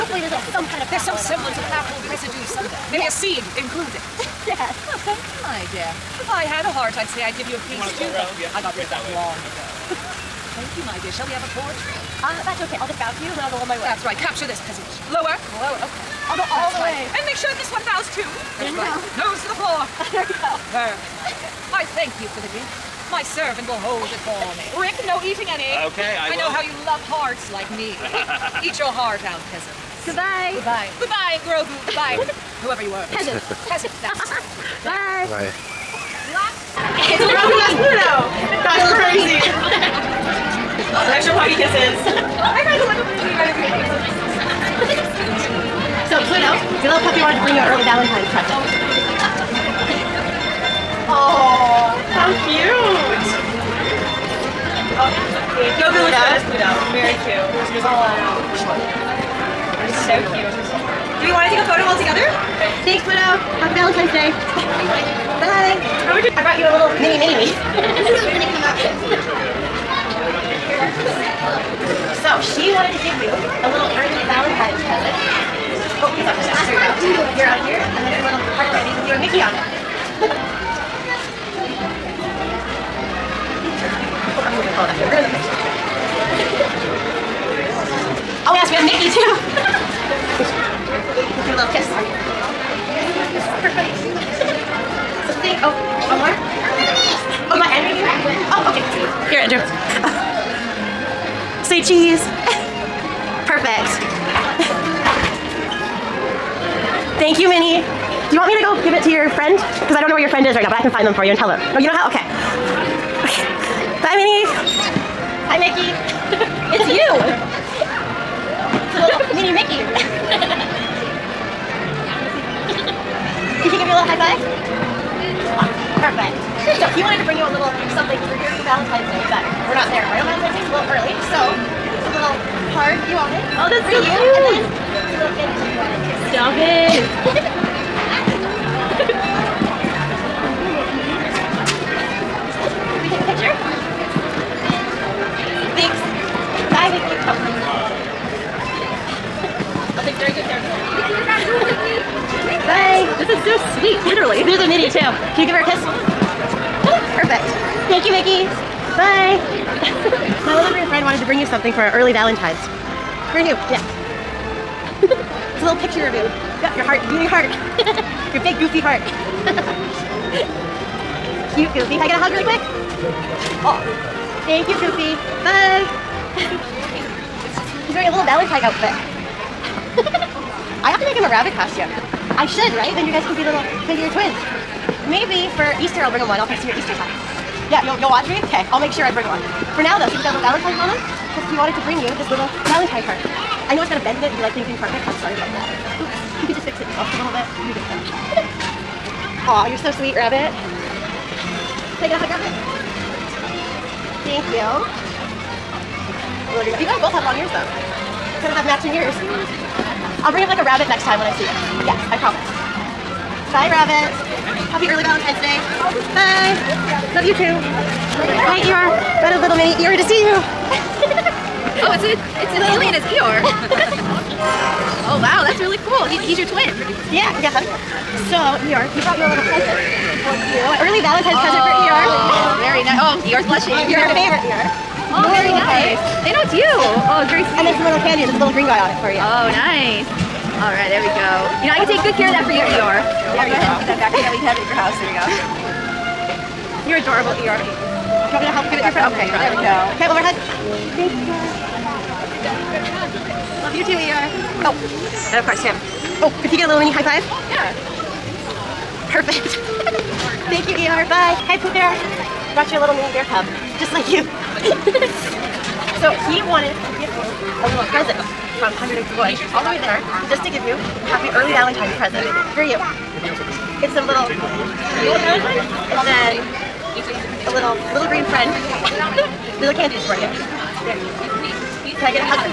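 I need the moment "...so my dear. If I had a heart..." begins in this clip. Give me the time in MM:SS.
00:05.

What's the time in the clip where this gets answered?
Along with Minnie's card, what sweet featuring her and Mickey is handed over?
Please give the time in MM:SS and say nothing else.
01:18.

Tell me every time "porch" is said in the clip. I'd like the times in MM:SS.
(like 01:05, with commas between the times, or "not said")
00:11.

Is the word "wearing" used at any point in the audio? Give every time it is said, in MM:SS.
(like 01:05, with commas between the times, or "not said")
02:57.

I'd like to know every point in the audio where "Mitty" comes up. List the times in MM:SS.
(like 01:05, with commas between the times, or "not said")
02:34.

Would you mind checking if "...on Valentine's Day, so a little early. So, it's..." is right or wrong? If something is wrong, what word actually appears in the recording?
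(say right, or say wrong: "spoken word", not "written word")
right.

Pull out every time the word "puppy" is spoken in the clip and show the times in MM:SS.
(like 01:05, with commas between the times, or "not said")
00:41, 00:47.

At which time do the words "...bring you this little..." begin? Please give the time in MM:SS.
03:11.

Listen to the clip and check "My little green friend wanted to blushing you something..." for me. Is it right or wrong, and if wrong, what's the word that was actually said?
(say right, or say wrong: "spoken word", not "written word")
wrong: "bring", not "blushing".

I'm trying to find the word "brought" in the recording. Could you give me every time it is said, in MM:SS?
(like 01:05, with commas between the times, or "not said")
03:39, 03:49, 04:22.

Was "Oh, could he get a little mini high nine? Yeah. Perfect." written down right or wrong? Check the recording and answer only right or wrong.
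wrong.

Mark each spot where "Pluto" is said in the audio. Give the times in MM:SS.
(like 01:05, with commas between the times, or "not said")
00:37, 00:46, 00:56.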